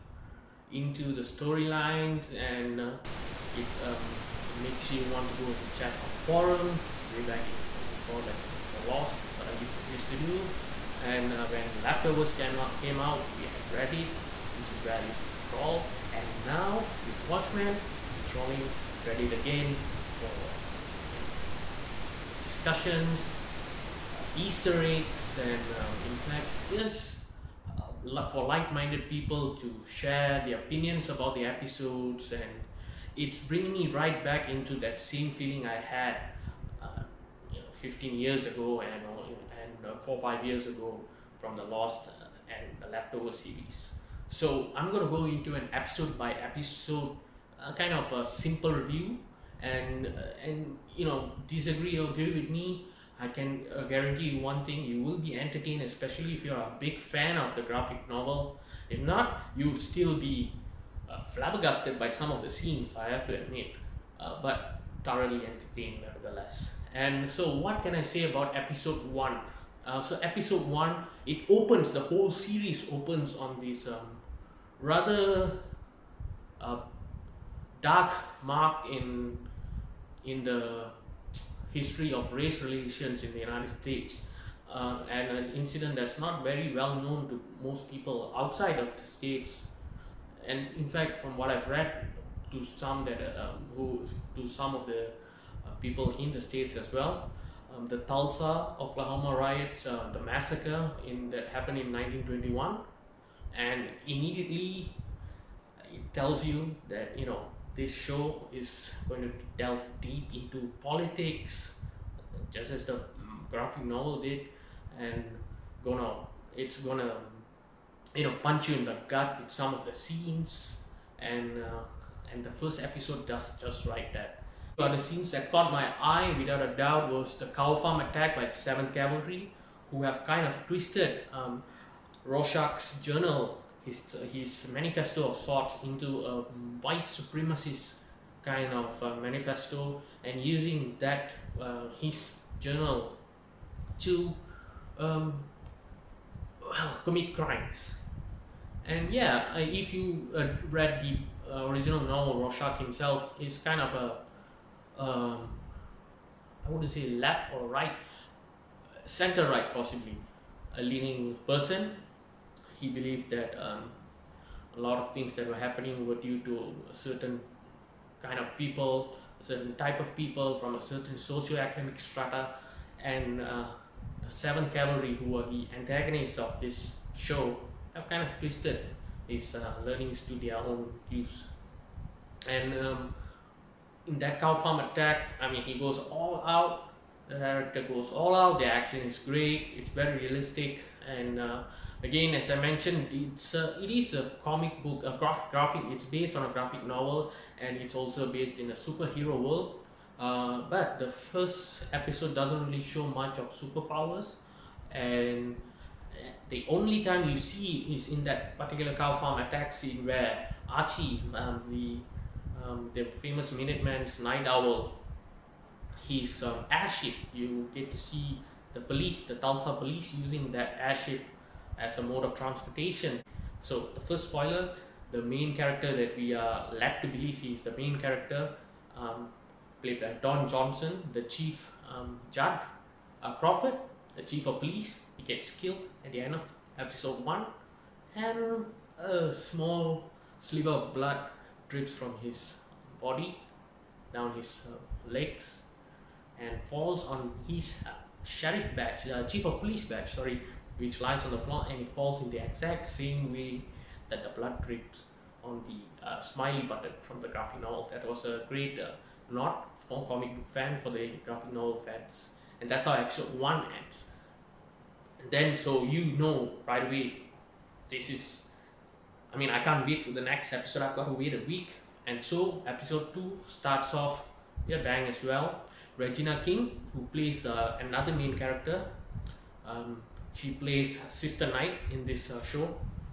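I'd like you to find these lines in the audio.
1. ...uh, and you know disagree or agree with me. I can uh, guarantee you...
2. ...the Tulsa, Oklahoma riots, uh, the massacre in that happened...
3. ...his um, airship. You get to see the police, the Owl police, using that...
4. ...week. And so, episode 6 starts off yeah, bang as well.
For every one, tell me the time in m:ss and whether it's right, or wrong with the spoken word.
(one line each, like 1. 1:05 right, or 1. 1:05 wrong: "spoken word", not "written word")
1. 0:50 right
2. 1:37 right
3. 3:36 wrong: "Tulsa", not "Owl"
4. 4:31 wrong: "2", not "6".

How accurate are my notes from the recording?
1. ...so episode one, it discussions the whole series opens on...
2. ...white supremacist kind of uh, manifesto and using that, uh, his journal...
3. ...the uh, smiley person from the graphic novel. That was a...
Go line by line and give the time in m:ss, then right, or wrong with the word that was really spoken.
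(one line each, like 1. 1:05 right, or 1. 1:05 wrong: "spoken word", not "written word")
1. 1:10 wrong: "opens", not "discussions"
2. 2:16 right
3. 4:15 wrong: "button", not "person".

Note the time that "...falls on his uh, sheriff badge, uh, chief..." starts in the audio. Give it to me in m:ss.
4:06.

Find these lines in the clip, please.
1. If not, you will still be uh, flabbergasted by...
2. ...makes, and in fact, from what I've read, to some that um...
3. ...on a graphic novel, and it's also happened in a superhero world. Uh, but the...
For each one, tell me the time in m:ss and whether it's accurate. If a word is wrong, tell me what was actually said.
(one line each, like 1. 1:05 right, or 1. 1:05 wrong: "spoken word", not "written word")
1. 0:58 right
2. 1:29 wrong: "states", not "makes"
3. 3:16 wrong: "based", not "happened".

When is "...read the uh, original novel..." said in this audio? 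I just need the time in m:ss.
2:30.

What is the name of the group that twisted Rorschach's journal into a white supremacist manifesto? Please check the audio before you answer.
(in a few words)
7th Cavalry.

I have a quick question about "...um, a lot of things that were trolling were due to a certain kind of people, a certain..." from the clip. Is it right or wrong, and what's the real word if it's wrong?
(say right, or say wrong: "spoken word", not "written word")
wrong: "happening", not "trolling".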